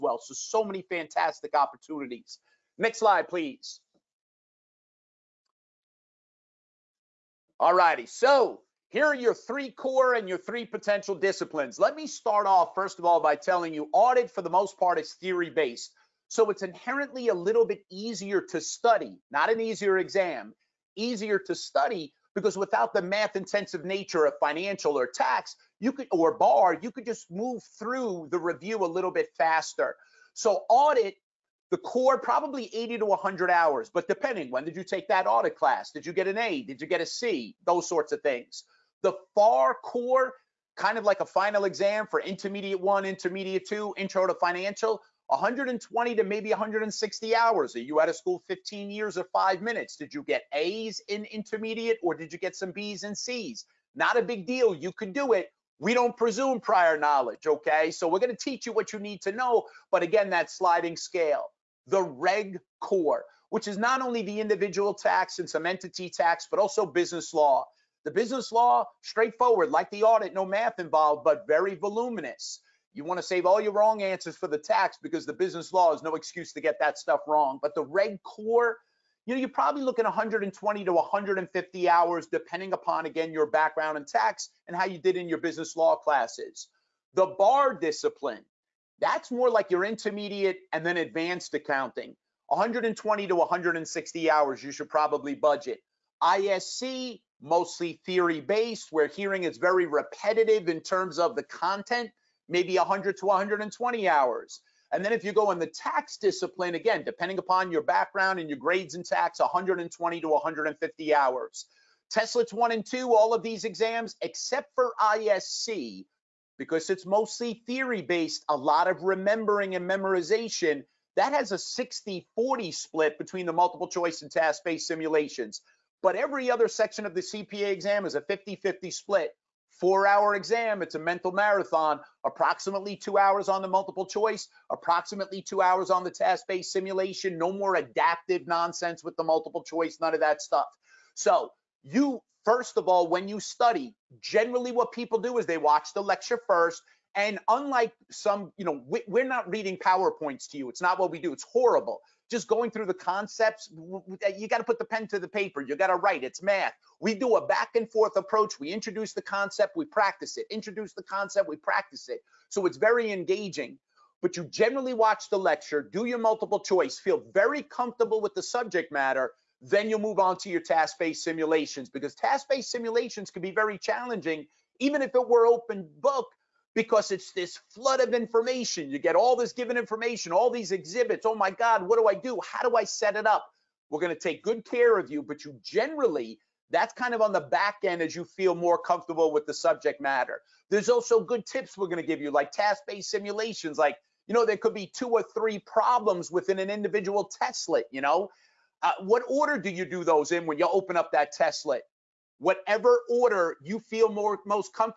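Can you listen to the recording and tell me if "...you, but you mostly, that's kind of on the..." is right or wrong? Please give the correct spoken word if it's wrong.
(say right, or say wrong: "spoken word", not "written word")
wrong: "generally", not "mostly".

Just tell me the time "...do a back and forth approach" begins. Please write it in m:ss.
2:37.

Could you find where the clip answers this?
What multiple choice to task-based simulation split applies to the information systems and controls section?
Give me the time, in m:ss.
2:01.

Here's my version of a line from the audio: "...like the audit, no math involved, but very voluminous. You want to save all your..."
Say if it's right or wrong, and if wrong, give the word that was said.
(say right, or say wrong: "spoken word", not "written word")
right.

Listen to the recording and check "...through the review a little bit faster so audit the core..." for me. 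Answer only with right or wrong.
right.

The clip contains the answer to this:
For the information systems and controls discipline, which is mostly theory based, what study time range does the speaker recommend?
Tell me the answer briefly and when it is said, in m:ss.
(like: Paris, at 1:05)
100 to 120 hours, at 1:42.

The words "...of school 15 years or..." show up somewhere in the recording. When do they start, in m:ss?
0:48.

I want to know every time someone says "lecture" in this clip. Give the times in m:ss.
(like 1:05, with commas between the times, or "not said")
2:26, 2:45.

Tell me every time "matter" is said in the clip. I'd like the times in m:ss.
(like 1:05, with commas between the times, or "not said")
2:48, 3:09.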